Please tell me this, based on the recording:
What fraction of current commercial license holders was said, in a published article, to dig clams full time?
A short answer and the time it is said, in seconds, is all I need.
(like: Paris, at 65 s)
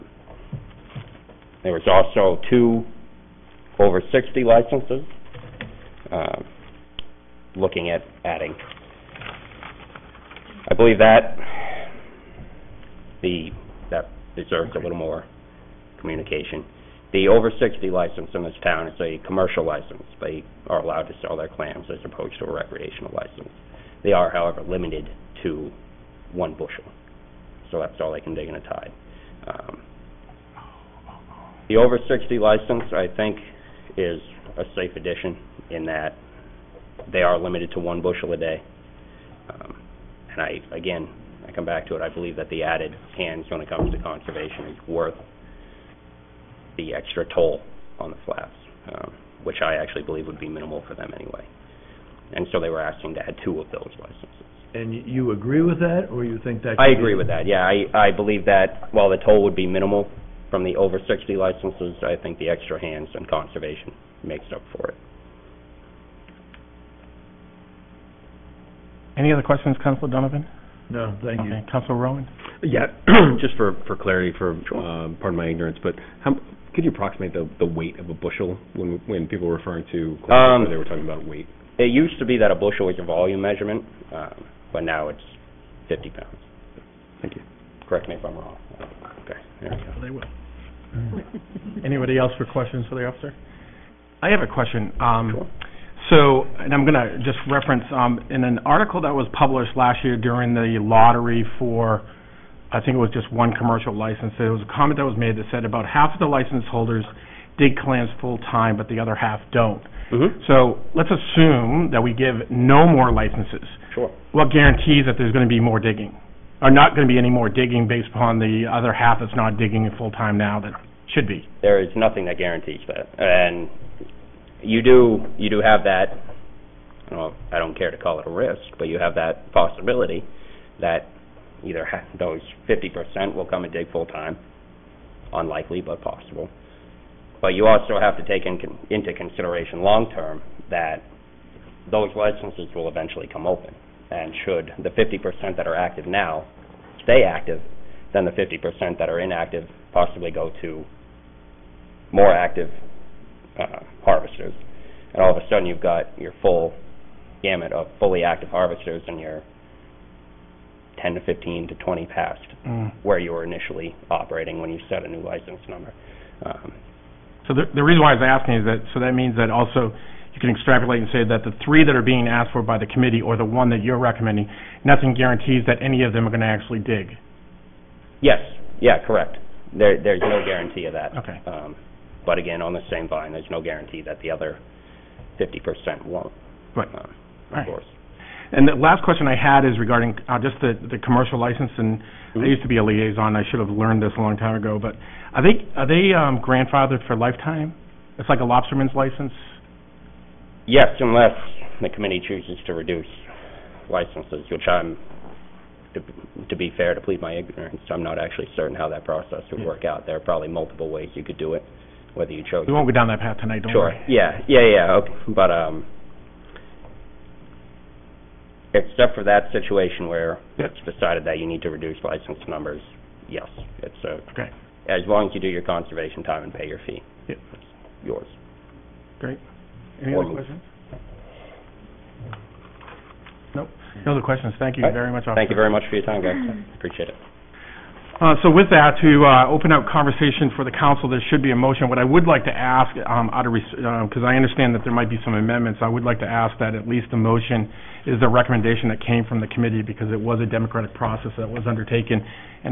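about half, at 105 s.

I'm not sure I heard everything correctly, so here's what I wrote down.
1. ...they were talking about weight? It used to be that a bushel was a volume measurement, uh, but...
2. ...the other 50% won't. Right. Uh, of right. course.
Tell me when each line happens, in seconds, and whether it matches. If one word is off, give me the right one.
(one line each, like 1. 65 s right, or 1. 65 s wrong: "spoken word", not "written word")
1. 80 s right
2. 184 s right.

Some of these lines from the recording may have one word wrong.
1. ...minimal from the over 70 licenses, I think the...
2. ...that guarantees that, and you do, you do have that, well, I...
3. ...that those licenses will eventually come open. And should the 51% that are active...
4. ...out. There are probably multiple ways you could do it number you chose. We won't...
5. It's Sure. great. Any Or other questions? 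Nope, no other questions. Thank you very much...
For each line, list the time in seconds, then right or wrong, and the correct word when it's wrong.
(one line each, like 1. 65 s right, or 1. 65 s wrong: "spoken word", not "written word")
1. 59 s wrong: "60", not "70"
2. 122 s right
3. 140 s wrong: "50", not "51"
4. 209 s wrong: "whether", not "number"
5. 227 s wrong: "Yours", not "Sure".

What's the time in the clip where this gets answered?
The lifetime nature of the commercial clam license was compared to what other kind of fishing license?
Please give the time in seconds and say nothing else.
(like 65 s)
198 s.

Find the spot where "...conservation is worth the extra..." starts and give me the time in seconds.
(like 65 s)
44 s.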